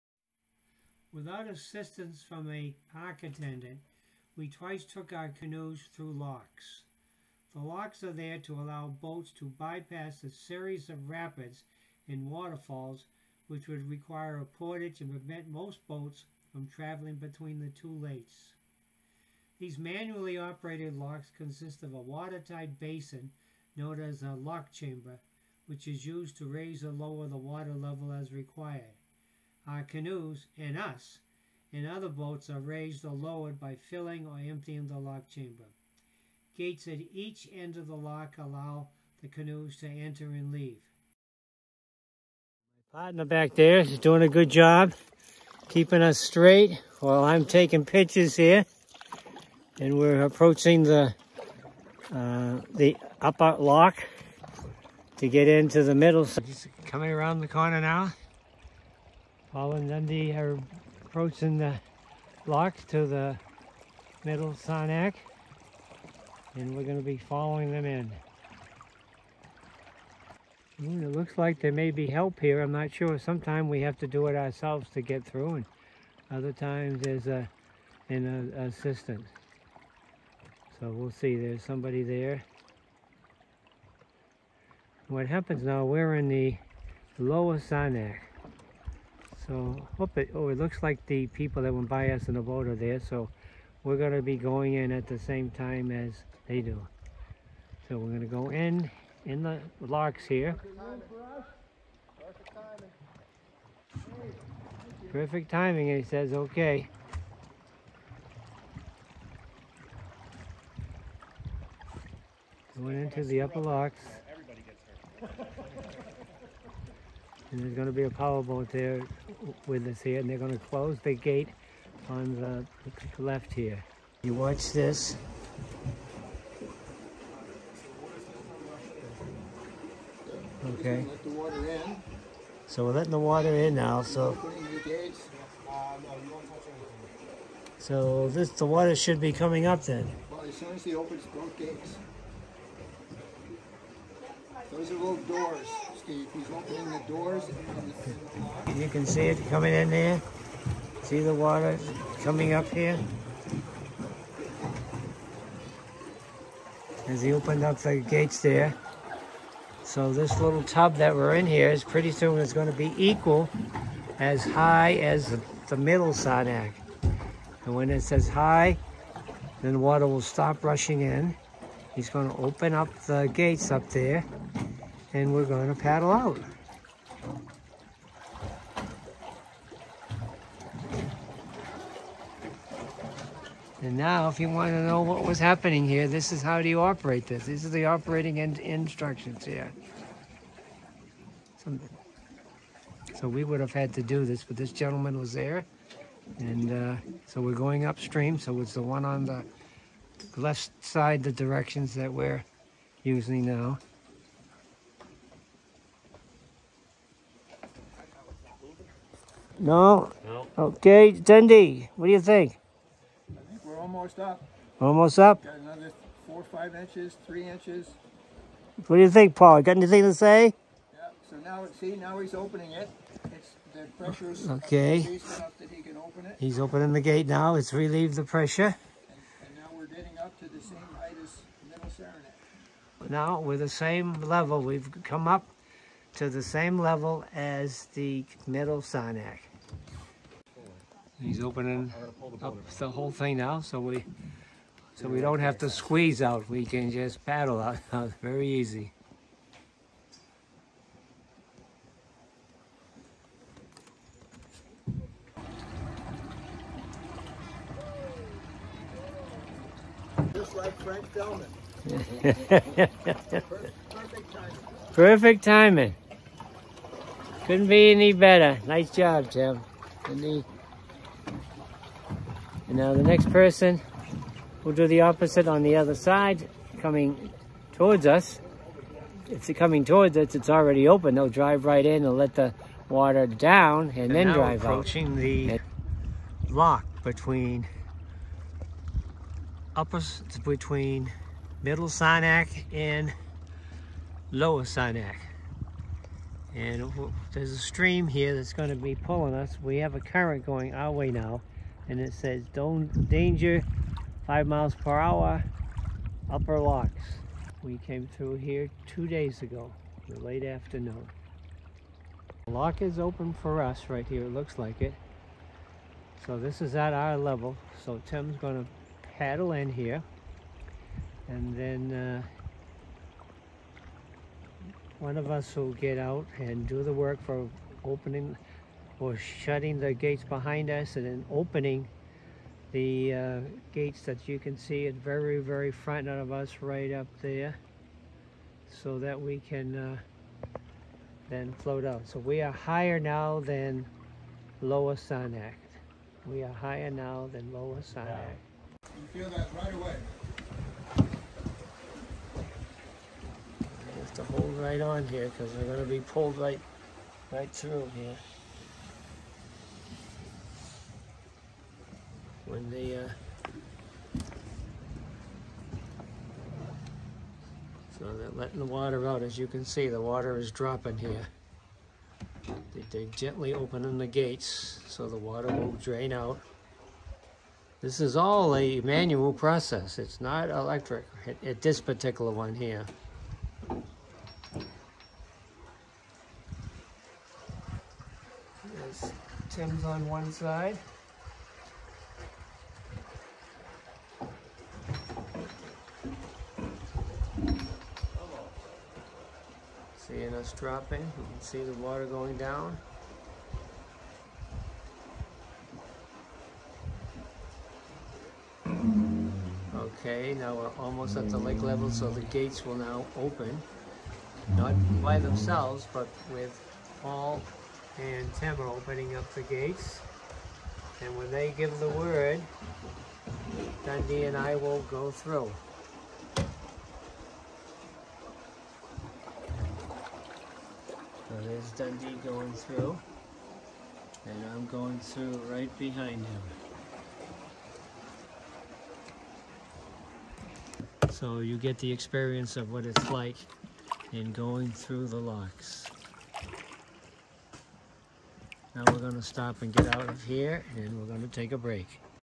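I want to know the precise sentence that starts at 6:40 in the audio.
Seeing us dropping, you can see the water going down.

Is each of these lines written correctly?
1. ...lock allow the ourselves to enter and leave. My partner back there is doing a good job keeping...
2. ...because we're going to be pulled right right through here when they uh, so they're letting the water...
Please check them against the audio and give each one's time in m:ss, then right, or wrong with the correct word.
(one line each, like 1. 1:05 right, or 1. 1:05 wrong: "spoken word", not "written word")
1. 0:37 wrong: "canoes", not "ourselves"
2. 5:55 right.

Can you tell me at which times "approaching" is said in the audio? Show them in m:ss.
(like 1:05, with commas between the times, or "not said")
0:50, 1:01, 4:44.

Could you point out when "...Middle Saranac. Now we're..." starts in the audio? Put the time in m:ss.
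3:51.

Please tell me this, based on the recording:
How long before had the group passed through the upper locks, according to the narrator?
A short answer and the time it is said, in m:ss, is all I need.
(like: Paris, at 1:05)
Two days ago, at 5:08.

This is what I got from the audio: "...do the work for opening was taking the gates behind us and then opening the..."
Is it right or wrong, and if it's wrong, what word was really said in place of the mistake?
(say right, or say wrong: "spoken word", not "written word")
wrong: "shutting", not "taking".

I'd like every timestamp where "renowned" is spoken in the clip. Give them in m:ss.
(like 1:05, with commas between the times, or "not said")
not said.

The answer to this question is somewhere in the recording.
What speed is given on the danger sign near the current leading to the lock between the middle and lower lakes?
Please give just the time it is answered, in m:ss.
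5:04.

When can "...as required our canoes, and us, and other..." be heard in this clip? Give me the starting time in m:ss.
0:28.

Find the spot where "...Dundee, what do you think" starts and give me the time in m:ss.
3:31.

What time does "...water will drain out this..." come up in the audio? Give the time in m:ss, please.
6:15.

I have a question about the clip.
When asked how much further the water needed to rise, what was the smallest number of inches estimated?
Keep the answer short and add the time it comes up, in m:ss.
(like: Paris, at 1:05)
3 inches, at 3:37.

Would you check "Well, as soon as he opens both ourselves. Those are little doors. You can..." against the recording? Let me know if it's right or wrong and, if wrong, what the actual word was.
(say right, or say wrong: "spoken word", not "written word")
wrong: "gates", not "ourselves".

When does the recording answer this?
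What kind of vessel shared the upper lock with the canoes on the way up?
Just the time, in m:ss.
1:58.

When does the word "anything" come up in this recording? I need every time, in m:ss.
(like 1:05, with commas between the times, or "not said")
3:39.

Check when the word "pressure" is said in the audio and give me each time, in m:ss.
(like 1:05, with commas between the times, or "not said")
3:44, 3:48.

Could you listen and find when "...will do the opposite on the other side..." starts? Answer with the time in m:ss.
4:34.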